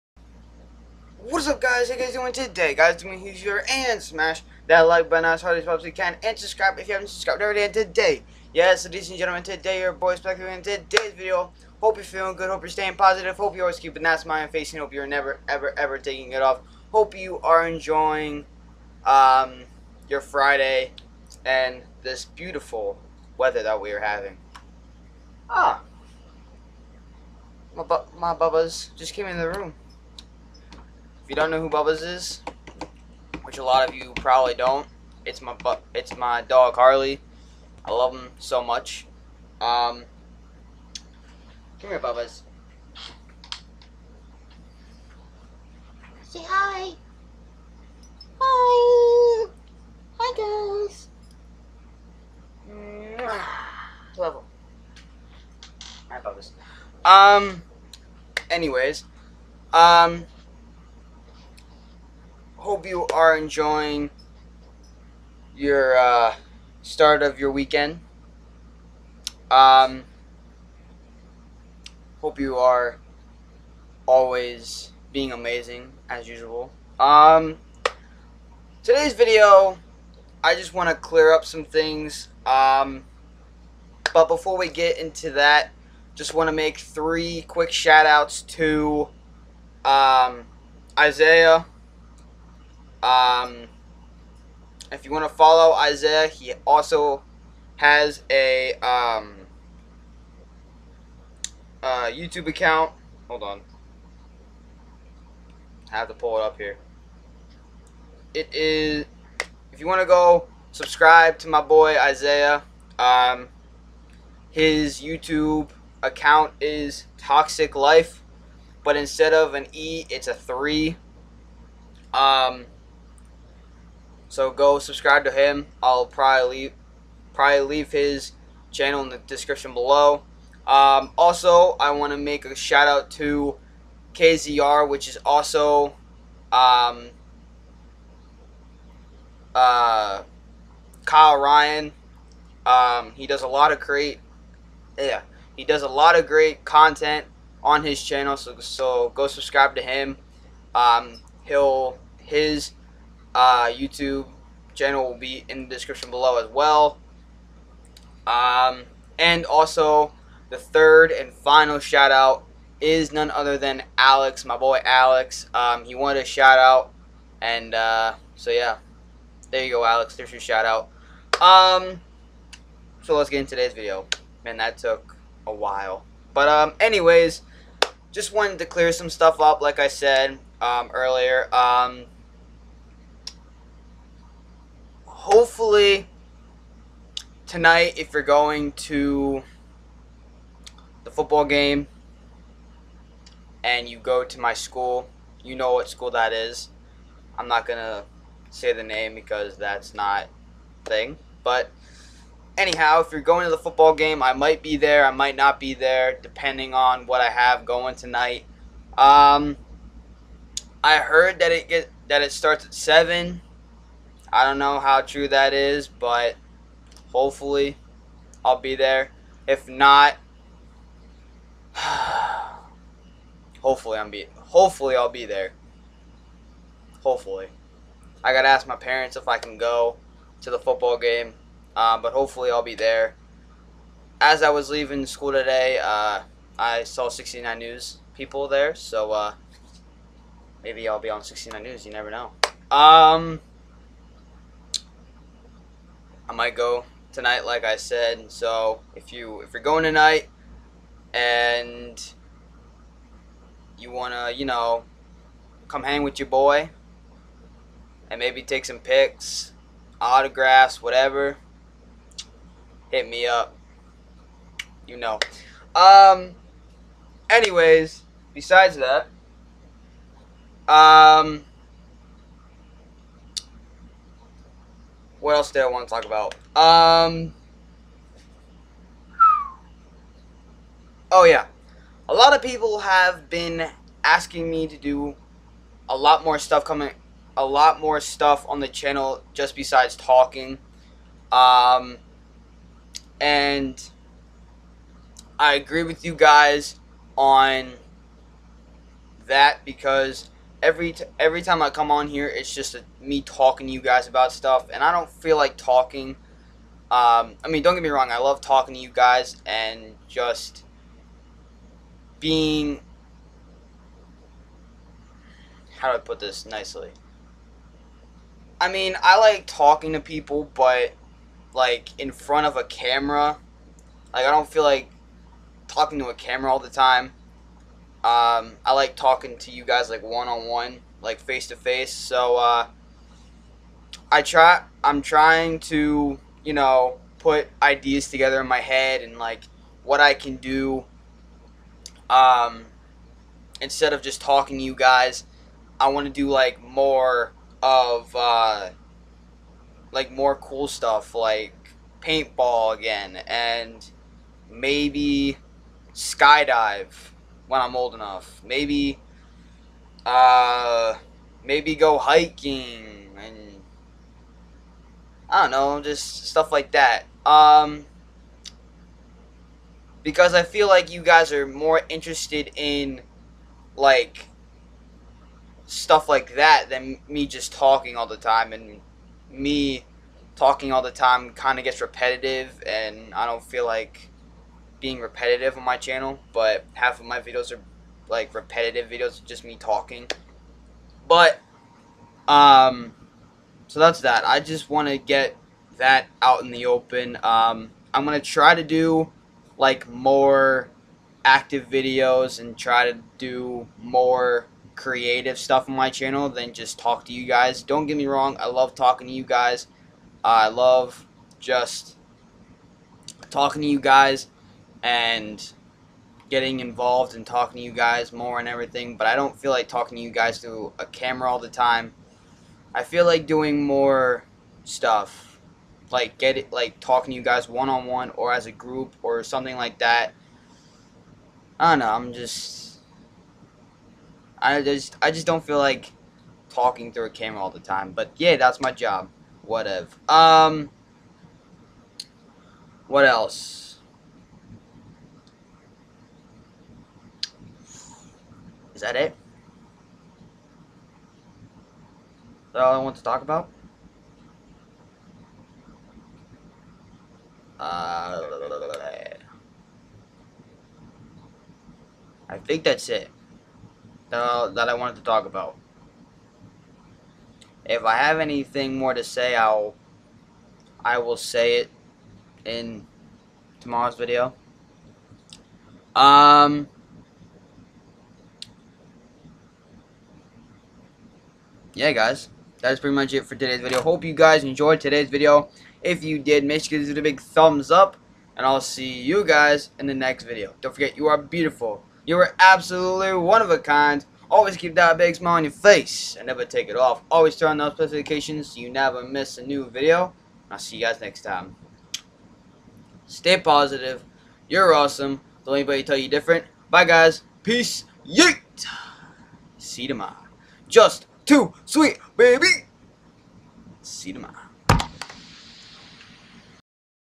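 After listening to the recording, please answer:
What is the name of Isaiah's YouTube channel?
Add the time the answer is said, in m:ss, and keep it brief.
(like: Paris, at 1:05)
Toxic Life, at 1:57.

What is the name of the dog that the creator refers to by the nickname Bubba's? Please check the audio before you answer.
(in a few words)
Harley.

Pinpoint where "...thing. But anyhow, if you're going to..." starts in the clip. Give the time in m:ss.
3:20.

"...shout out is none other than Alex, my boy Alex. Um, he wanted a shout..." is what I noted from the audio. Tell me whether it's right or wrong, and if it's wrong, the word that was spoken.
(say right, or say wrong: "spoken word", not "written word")
right.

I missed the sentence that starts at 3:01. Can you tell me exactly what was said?
Um, hopefully tonight, if you're going to the football game and you go to my school, you know what school that is.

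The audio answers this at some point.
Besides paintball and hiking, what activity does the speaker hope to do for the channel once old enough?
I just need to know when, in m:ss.
5:55.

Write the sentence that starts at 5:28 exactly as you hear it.
Um, I like talking to you guys like one on one, like face to face.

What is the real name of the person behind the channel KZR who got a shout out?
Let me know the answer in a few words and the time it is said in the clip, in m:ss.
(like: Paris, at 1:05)
Kyle Ryan, at 2:21.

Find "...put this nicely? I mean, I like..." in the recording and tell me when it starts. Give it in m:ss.
5:15.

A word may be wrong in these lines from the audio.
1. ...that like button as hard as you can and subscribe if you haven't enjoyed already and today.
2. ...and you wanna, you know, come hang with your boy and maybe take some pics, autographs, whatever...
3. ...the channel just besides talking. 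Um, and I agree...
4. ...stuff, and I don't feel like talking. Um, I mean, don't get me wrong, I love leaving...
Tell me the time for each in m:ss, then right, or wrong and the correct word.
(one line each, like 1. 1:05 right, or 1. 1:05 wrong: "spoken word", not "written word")
1. 0:04 wrong: "subscribed", not "enjoyed"
2. 4:11 right
3. 4:48 right
4. 5:04 wrong: "talking", not "leaving".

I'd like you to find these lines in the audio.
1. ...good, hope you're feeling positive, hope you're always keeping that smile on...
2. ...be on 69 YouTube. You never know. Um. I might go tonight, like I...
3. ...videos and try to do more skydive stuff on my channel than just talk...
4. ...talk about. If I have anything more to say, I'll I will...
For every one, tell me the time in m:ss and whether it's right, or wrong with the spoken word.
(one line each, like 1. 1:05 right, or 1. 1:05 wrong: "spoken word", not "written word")
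1. 0:12 wrong: "staying", not "feeling"
2. 4:00 wrong: "News", not "YouTube"
3. 6:41 wrong: "creative", not "skydive"
4. 7:45 right.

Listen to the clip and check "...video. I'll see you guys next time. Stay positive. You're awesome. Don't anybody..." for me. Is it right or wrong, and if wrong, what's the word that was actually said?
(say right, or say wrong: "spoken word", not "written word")
right.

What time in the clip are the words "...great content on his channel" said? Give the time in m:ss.
2:26.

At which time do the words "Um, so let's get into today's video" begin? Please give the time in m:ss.
2:51.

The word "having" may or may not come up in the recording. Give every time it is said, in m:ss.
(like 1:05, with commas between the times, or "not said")
0:24.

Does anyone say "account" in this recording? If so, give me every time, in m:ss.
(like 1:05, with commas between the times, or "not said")
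1:42, 1:56.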